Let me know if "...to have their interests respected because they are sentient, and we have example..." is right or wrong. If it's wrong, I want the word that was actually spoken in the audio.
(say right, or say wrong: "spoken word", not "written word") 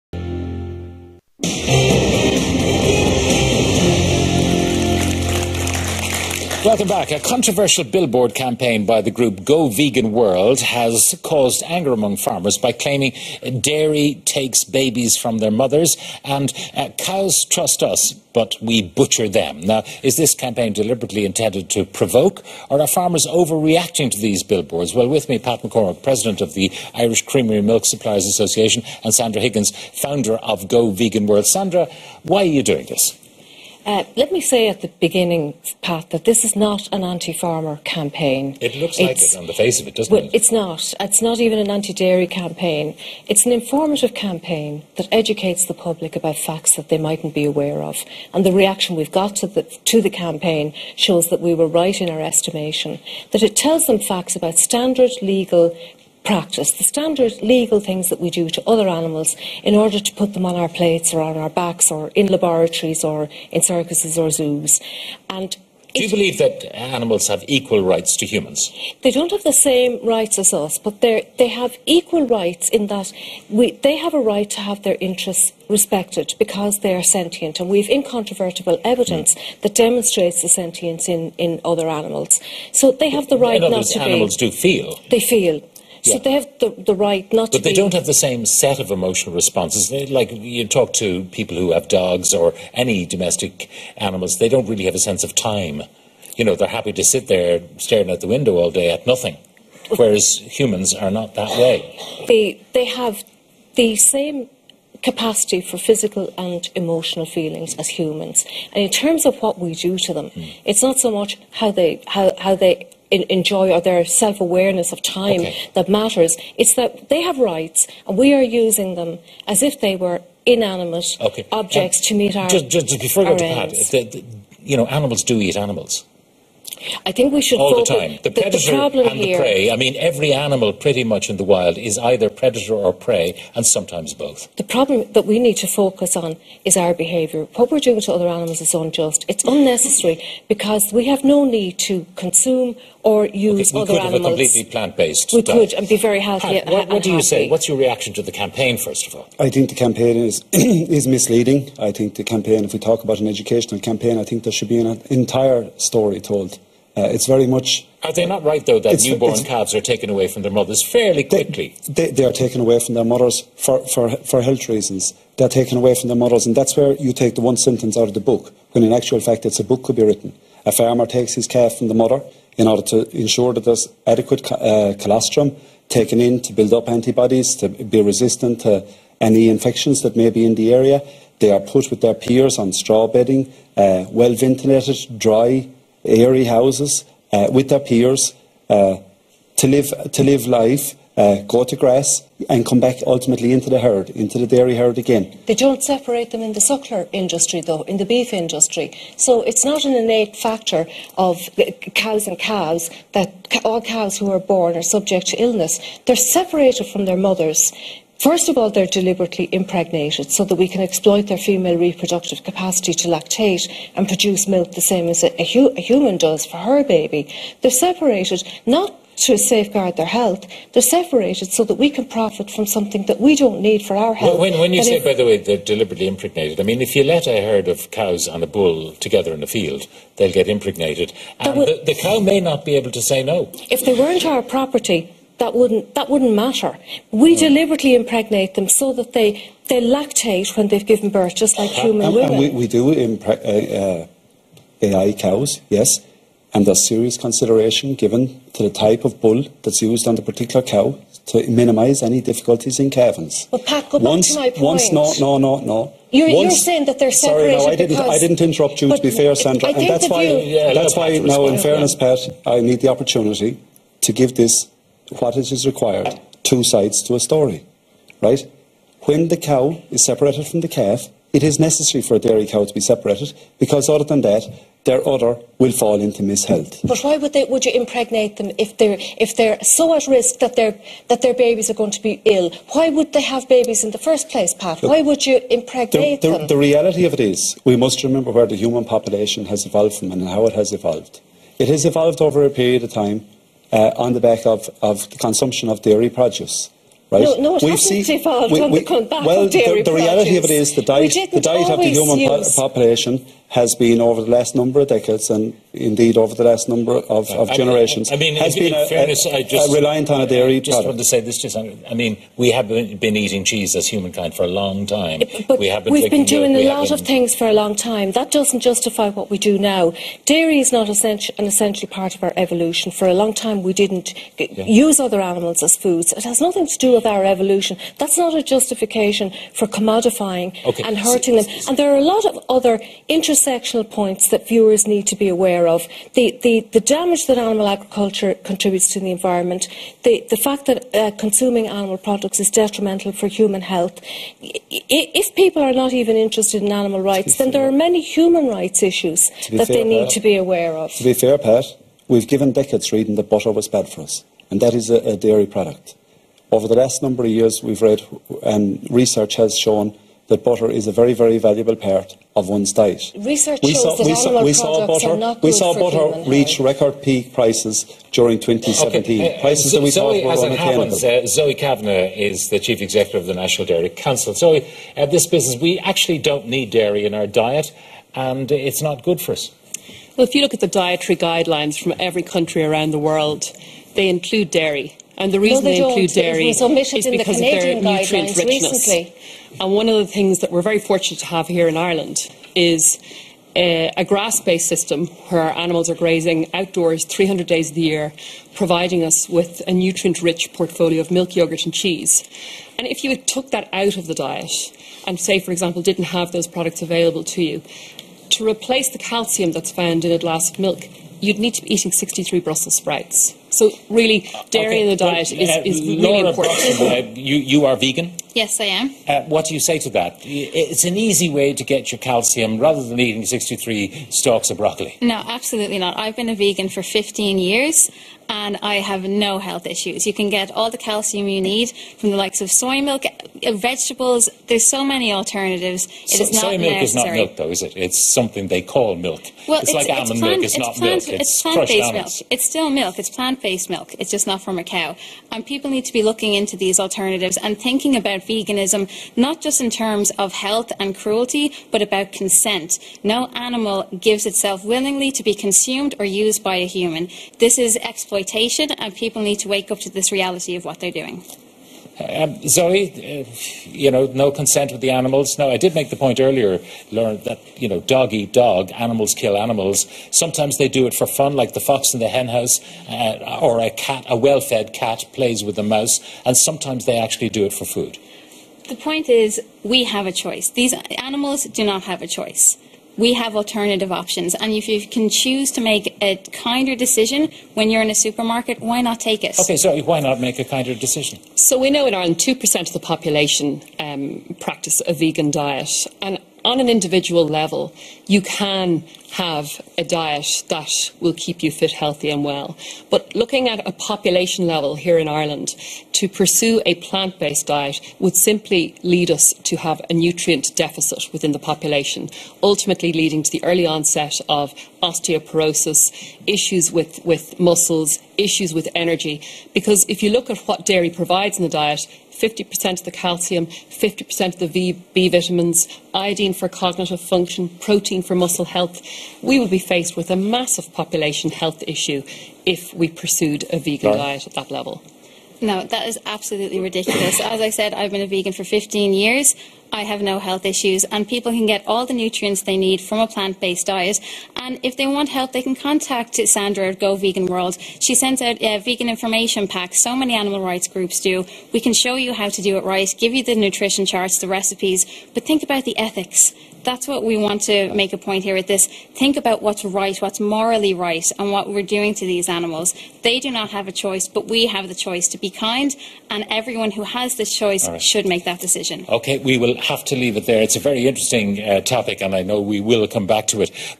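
wrong: "incontrovertible", not "example".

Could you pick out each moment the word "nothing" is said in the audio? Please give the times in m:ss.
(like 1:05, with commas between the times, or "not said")
1:39, 5:26.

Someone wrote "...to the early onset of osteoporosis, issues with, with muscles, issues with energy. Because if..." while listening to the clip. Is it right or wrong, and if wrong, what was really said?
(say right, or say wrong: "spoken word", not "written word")
right.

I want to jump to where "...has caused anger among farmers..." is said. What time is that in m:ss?
0:10.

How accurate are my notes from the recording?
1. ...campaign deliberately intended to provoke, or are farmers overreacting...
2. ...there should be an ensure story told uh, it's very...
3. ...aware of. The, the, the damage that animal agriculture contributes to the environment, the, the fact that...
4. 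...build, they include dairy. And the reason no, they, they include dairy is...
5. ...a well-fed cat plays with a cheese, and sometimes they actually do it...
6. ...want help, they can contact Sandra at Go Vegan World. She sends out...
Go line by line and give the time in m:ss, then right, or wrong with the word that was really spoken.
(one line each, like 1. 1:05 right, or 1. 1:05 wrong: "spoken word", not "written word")
1. 0:20 right
2. 2:34 wrong: "entire", not "ensure"
3. 5:35 right
4. 6:22 wrong: "world", not "build"
5. 7:54 wrong: "mouse", not "cheese"
6. 9:04 right.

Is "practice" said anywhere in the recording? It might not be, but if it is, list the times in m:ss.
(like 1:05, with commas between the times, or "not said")
0:56, 8:14.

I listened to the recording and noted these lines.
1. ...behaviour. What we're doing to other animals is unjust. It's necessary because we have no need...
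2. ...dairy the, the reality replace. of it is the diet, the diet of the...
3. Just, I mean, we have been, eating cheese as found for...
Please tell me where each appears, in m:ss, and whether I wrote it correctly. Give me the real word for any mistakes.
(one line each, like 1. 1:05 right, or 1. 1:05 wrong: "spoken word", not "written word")
1. 2:16 wrong: "unnecessary", not "necessary"
2. 4:59 wrong: "produce", not "replace"
3. 5:11 wrong: "humankind", not "found".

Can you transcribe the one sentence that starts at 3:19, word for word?
So it's not an innate factor of cows and cows that all cows who are born are subject to illness.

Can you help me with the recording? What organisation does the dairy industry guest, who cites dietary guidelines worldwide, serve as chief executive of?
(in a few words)
National Dairy Council.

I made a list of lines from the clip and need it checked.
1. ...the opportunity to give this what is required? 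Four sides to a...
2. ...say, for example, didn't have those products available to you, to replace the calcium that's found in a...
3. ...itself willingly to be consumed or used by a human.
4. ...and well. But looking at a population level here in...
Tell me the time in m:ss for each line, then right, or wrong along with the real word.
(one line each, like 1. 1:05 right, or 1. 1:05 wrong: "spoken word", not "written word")
1. 4:22 wrong: "Two", not "Four"
2. 6:45 right
3. 7:34 right
4. 8:22 right.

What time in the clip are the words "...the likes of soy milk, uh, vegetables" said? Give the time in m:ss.
7:12.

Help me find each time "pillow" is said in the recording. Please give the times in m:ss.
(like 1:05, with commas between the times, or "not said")
not said.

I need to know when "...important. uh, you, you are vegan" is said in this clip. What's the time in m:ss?
6:56.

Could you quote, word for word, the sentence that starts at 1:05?
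And do you believe that animals have equal rights to humans?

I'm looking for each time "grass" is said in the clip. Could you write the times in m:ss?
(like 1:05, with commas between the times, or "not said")
3:11, 6:34.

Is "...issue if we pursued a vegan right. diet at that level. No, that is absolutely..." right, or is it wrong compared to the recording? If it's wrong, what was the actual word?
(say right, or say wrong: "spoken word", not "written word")
right.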